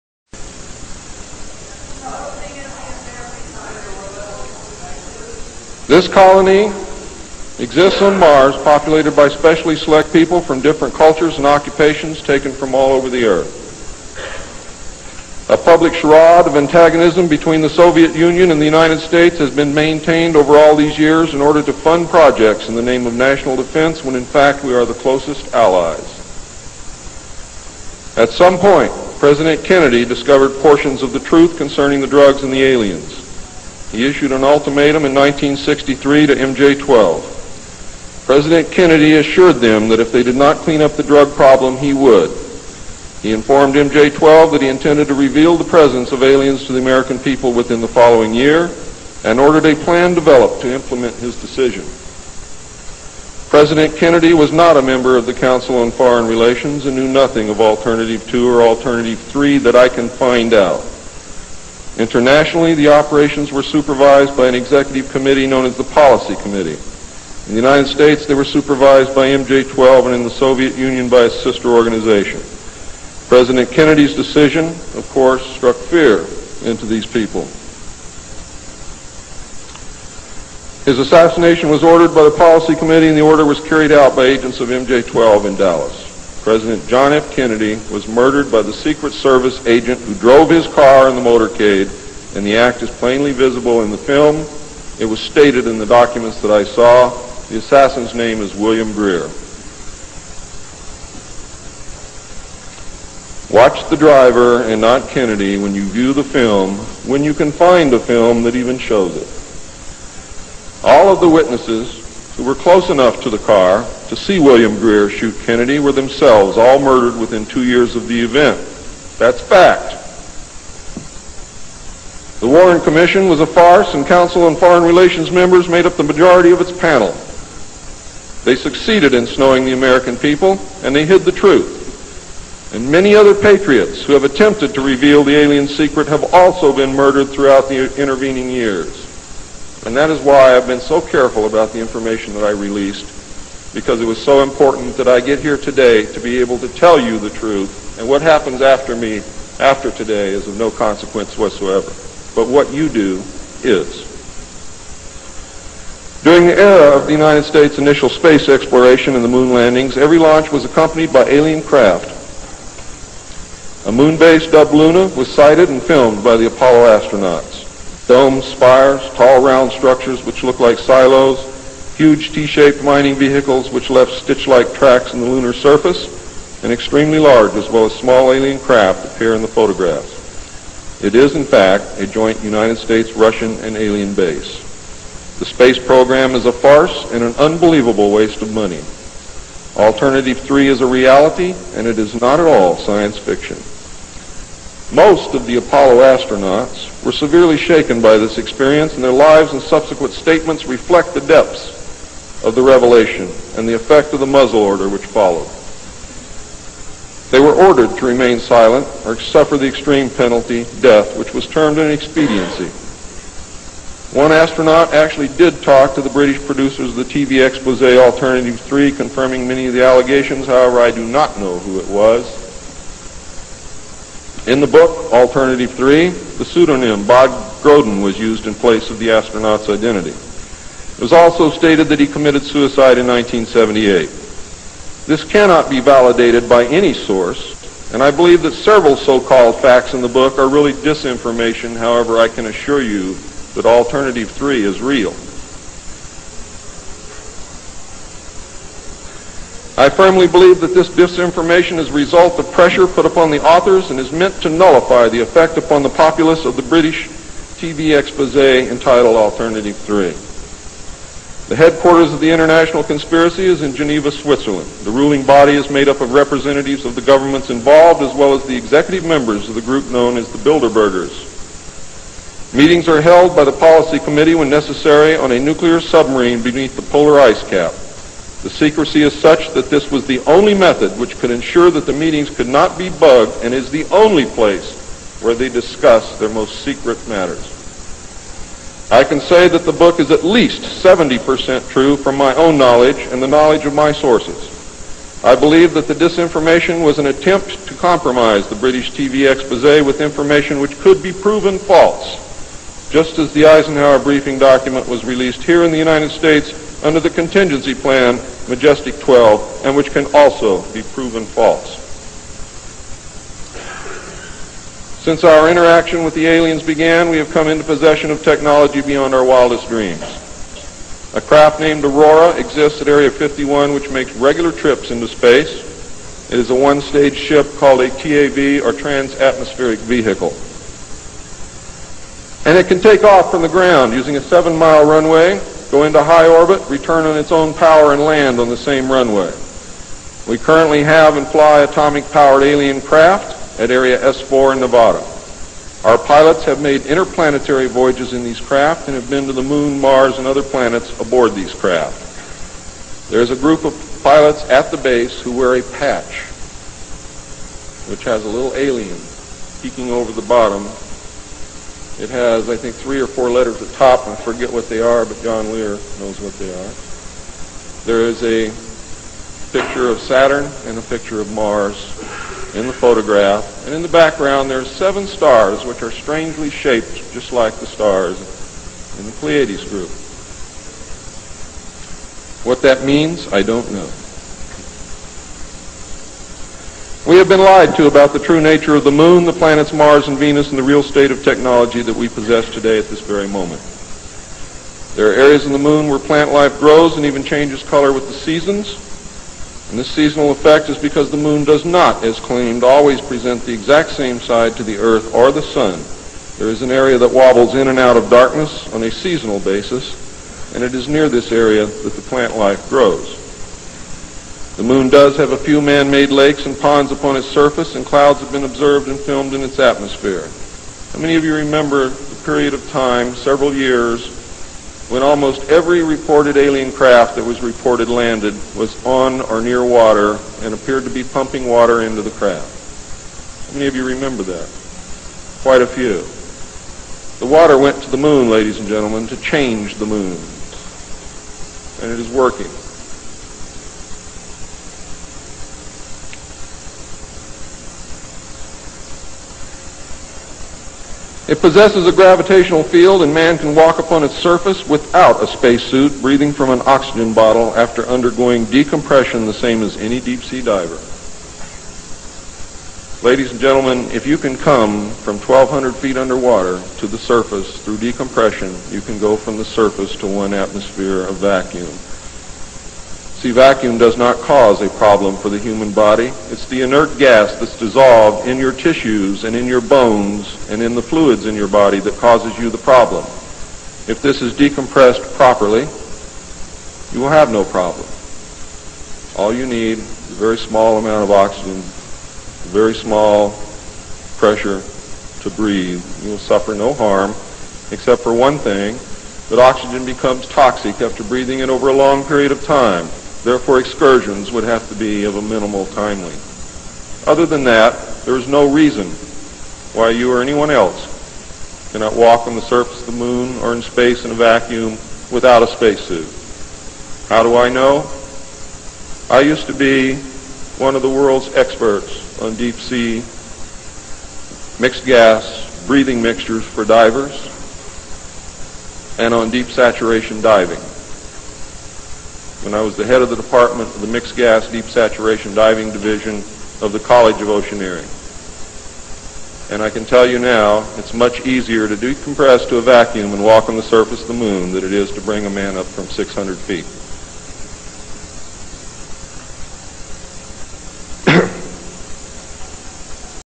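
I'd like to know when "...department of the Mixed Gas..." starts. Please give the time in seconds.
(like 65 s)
533 s.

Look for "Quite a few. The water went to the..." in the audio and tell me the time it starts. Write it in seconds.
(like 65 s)
435 s.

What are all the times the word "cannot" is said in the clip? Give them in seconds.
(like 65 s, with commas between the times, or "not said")
235 s, 511 s.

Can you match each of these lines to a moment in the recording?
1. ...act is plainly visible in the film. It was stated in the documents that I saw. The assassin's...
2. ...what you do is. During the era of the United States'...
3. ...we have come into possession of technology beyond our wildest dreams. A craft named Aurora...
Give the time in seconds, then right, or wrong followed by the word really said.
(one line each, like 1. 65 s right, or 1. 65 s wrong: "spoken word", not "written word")
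1. 92 s right
2. 152 s right
3. 317 s right.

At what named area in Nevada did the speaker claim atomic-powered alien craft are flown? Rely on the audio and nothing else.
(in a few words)
Area S4.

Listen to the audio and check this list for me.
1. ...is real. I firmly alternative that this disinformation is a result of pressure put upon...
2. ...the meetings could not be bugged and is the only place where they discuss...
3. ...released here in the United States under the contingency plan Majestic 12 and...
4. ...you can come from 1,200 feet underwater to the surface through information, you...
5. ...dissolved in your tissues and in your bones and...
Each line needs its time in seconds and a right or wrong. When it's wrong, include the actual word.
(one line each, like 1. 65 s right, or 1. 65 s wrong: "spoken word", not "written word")
1. 244 s wrong: "believe", not "alternative"
2. 281 s right
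3. 305 s right
4. 464 s wrong: "decompression", not "information"
5. 477 s right.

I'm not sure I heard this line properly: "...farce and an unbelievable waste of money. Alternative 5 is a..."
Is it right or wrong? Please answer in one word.
wrong.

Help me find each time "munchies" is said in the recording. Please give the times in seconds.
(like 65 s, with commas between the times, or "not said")
not said.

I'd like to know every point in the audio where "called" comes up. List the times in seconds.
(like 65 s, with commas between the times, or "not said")
238 s, 327 s.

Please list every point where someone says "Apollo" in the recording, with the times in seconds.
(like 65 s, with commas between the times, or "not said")
166 s, 195 s.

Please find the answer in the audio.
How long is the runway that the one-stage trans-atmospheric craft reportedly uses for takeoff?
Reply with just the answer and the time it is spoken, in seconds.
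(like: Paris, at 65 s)
7 miles, at 334 s.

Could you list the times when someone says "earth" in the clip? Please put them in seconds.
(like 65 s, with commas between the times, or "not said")
13 s, 404 s.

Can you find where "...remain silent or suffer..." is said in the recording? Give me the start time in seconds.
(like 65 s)
208 s.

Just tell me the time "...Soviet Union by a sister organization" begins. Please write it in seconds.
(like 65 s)
70 s.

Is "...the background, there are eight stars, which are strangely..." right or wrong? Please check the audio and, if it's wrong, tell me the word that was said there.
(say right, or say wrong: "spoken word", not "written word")
wrong: "seven", not "eight".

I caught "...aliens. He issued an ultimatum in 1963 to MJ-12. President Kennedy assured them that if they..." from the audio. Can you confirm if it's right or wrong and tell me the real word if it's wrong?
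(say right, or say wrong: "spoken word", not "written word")
right.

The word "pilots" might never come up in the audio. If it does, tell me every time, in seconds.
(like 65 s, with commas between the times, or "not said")
345 s, 354 s.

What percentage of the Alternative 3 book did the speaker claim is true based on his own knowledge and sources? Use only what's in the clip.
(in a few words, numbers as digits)
70%.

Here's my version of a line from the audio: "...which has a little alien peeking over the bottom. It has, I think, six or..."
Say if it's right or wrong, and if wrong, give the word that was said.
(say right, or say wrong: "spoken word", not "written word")
wrong: "three", not "six".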